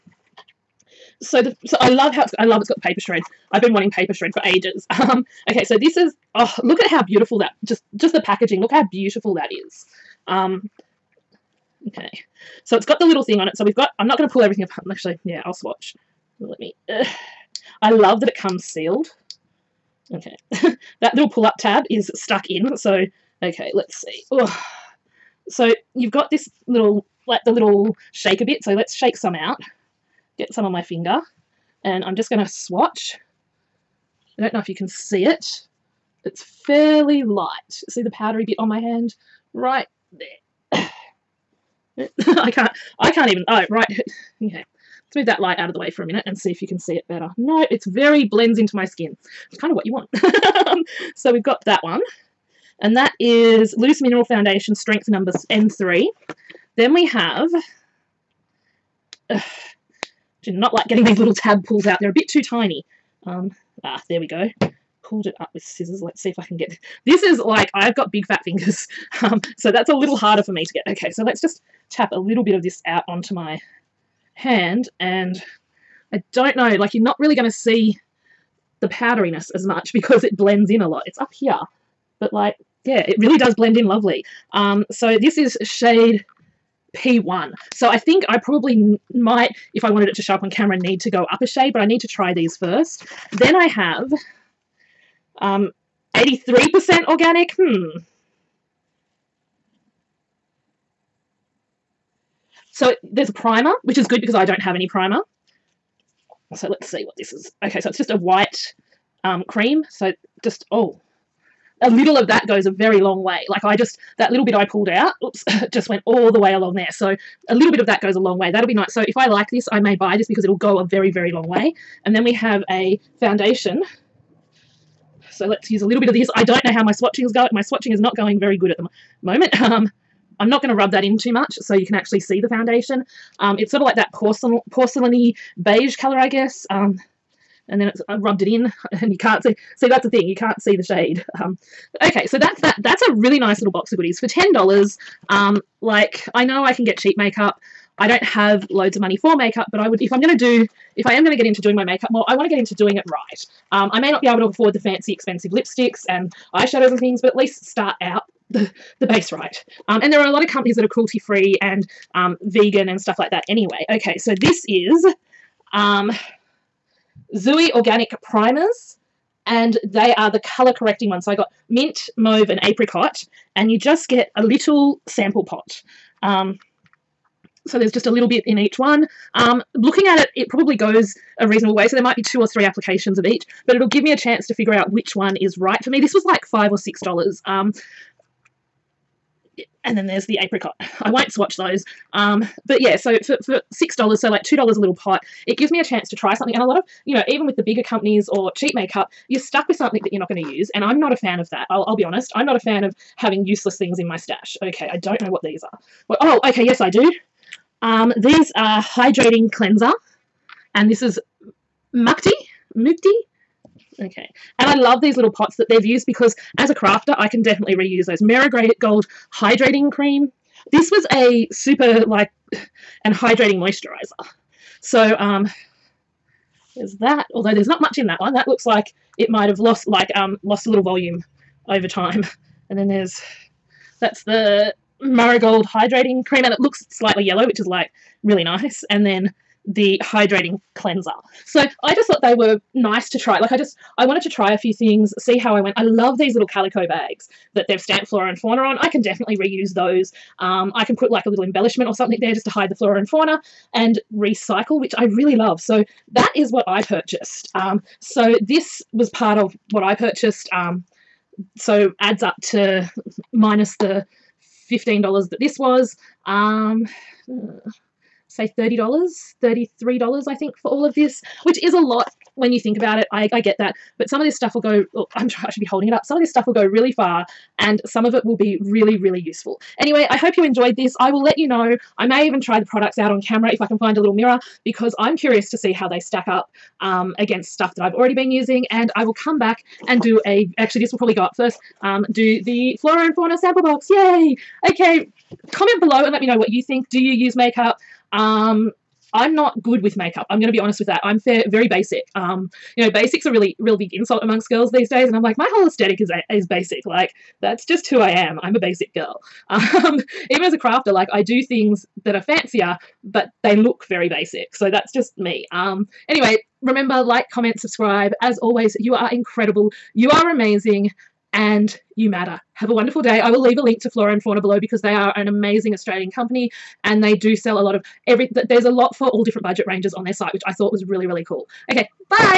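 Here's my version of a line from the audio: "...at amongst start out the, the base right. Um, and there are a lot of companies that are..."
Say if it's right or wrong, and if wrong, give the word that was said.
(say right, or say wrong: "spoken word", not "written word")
wrong: "least", not "amongst".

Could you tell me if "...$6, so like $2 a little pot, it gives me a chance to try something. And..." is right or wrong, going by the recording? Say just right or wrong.
right.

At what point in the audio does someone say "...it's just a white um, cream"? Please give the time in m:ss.
1:47.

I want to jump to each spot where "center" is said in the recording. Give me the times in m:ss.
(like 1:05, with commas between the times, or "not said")
not said.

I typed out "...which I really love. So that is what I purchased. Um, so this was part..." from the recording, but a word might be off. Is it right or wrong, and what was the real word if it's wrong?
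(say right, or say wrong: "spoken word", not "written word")
right.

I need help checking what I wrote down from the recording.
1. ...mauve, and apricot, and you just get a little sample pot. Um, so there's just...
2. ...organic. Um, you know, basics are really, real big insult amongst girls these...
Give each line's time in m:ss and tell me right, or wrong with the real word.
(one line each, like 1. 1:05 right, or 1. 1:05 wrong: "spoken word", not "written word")
1. 2:52 right
2. 5:01 wrong: "basic", not "organic".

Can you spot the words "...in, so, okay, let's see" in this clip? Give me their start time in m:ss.
0:22.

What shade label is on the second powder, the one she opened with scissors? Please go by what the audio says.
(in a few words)
P1.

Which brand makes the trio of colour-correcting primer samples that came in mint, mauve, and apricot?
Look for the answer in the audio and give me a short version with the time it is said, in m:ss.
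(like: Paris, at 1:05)
Zuii Organic, at 2:47.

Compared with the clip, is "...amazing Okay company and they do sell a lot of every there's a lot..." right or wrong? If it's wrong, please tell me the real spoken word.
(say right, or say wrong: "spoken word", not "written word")
wrong: "Australian", not "Okay".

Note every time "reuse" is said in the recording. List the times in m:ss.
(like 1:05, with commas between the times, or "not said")
3:37, 4:09.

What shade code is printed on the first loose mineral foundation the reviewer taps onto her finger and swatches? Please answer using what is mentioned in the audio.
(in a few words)
N3.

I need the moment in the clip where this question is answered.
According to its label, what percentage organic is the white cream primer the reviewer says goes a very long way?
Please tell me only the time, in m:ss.
1:36.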